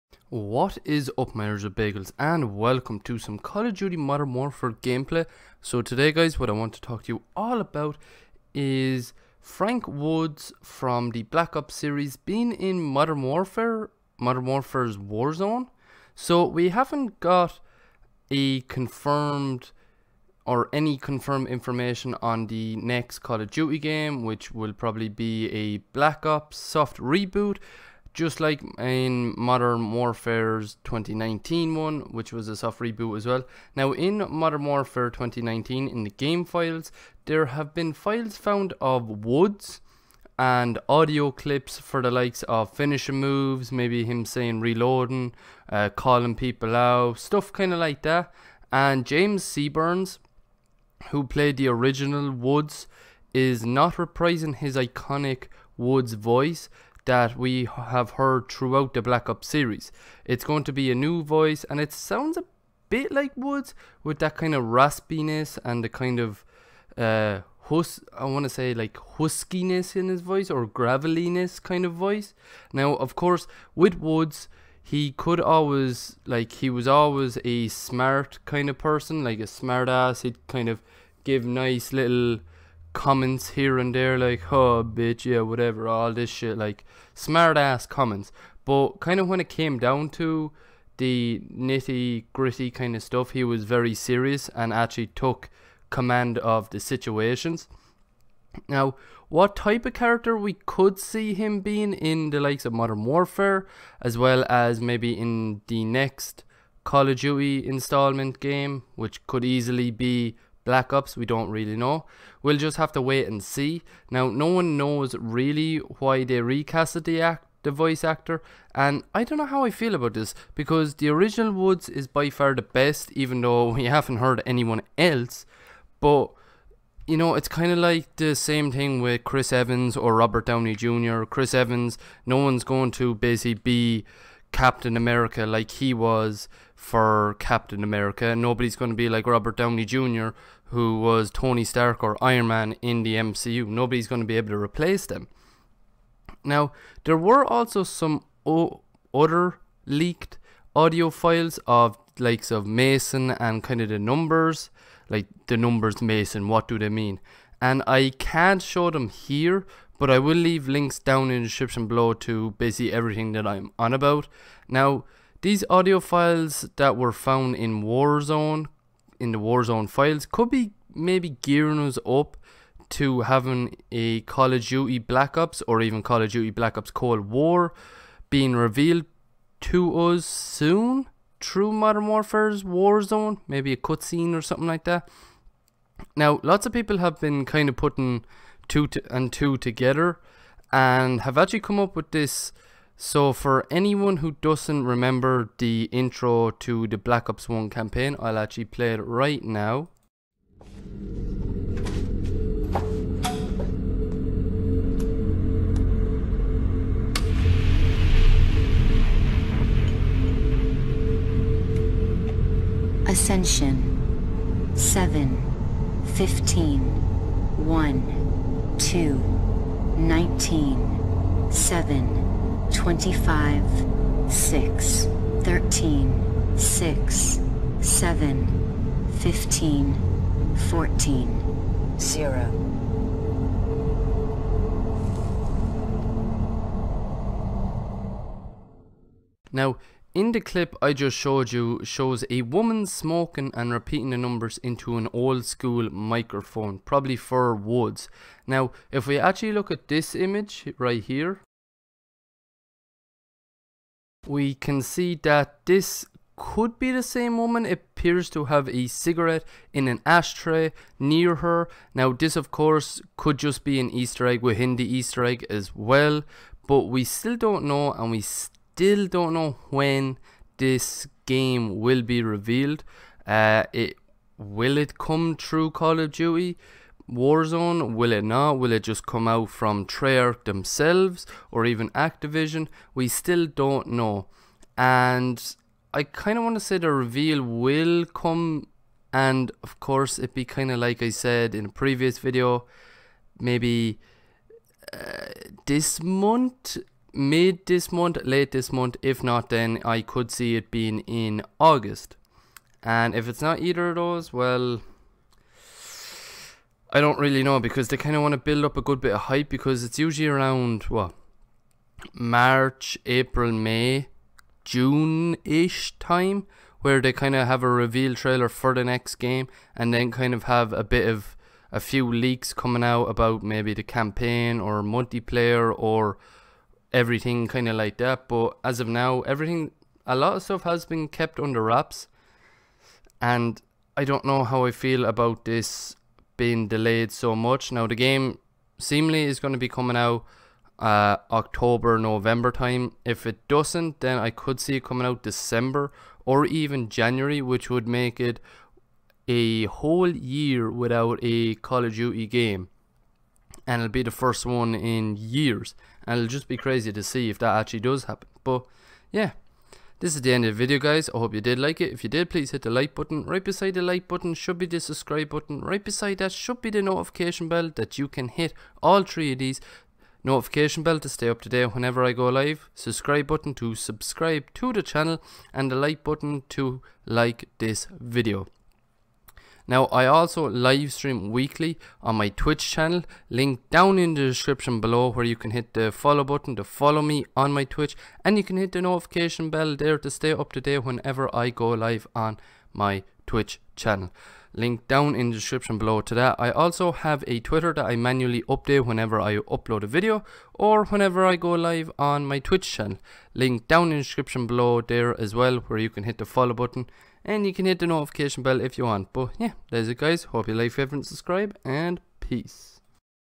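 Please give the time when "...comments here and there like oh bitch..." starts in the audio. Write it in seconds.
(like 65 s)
82 s.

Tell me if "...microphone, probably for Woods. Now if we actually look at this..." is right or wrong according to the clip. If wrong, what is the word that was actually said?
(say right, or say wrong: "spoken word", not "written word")
right.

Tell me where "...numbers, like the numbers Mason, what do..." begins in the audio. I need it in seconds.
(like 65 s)
153 s.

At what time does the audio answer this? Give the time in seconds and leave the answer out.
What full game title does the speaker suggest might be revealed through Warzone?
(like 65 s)
176 s.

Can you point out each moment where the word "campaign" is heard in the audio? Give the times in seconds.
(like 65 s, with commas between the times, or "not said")
197 s, 323 s.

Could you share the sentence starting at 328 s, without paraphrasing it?
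But as of now, everything, a lot of stuff has been kept under wraps.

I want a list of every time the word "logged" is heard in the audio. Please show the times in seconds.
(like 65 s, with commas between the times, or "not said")
not said.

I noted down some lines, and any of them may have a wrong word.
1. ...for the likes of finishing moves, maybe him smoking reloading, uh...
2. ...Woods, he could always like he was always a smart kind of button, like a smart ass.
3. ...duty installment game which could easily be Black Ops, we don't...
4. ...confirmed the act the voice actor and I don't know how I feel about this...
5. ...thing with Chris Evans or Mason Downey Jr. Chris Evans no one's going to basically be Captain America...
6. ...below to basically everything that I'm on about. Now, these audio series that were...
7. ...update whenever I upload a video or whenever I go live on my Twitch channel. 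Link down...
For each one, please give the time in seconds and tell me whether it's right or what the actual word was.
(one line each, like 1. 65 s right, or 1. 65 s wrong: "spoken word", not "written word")
1. 41 s wrong: "saying", not "smoking"
2. 73 s wrong: "person", not "button"
3. 107 s right
4. 116 s wrong: "recasted", not "confirmed"
5. 128 s wrong: "Robert", not "Mason"
6. 161 s wrong: "files", not "series"
7. 398 s right.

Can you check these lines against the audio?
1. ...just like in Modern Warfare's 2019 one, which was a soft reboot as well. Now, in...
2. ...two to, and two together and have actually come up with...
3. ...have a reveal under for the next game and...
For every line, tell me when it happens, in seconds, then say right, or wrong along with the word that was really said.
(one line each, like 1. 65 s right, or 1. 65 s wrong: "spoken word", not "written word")
1. 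28 s right
2. 188 s right
3. 317 s wrong: "trailer", not "under".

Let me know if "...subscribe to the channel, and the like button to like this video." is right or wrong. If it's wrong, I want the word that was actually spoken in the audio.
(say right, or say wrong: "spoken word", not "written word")
right.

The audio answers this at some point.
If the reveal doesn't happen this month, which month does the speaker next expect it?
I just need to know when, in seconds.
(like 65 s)
301 s.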